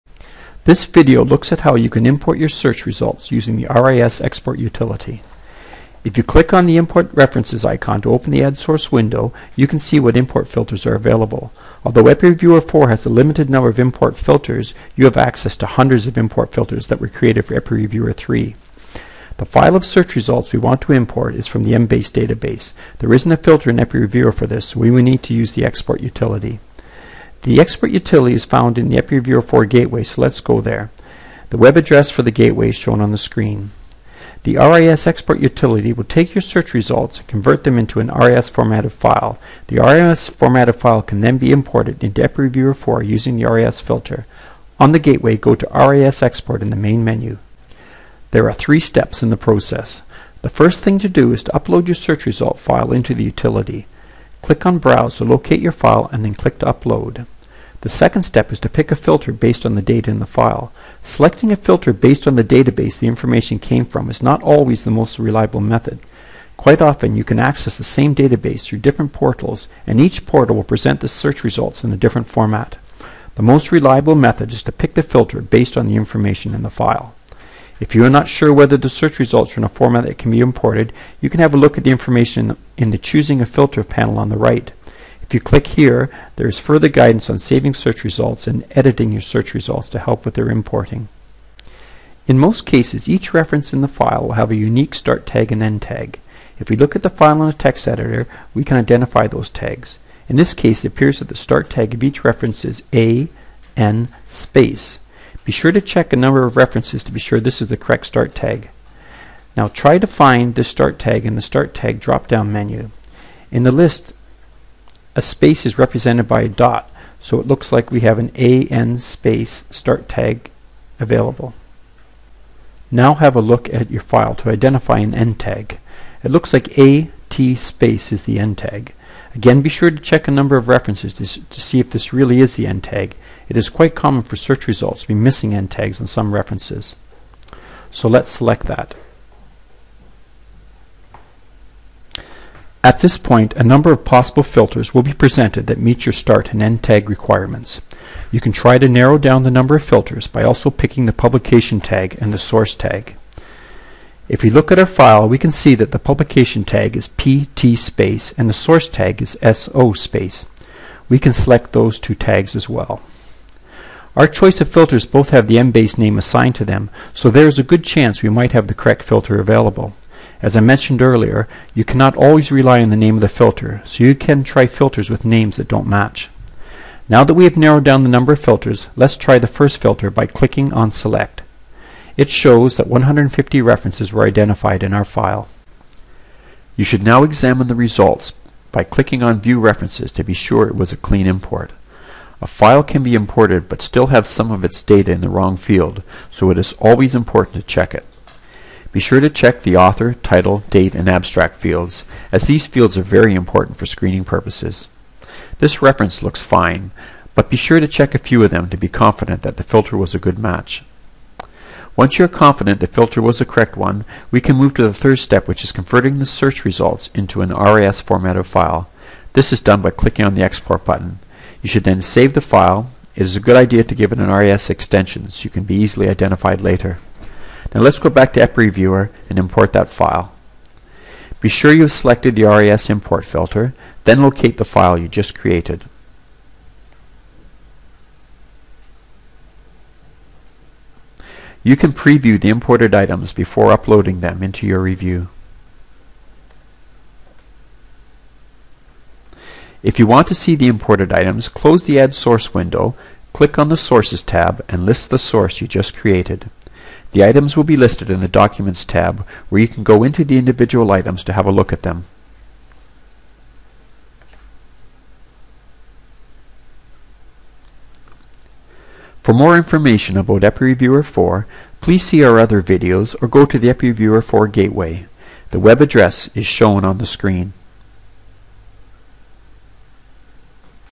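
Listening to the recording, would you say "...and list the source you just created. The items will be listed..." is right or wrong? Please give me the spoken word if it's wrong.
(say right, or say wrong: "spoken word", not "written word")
right.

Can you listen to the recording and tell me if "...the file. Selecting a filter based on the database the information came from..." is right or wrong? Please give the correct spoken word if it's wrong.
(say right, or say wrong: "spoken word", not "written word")
right.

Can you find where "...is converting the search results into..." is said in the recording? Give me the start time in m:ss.
3:35.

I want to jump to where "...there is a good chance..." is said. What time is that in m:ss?
2:47.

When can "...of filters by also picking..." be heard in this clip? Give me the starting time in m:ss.
2:29.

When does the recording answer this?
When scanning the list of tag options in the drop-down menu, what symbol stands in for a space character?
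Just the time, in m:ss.
1:56.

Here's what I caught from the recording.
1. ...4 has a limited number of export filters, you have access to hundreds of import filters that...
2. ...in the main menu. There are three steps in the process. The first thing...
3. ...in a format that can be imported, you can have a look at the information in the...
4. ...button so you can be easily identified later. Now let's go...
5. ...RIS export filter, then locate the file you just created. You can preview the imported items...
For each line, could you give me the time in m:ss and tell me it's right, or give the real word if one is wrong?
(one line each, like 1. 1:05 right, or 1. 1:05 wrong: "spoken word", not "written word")
1. 0:12 wrong: "import", not "export"
2. 0:46 right
3. 1:19 right
4. 3:44 wrong: "extension", not "button"
5. 3:52 wrong: "import", not "export".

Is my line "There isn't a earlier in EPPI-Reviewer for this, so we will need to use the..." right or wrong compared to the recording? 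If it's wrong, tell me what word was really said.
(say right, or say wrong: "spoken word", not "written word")
wrong: "filter", not "earlier".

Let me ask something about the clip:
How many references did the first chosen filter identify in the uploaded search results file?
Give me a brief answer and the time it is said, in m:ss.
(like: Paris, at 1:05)
150, at 3:02.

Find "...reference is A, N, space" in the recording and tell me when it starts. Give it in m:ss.
1:42.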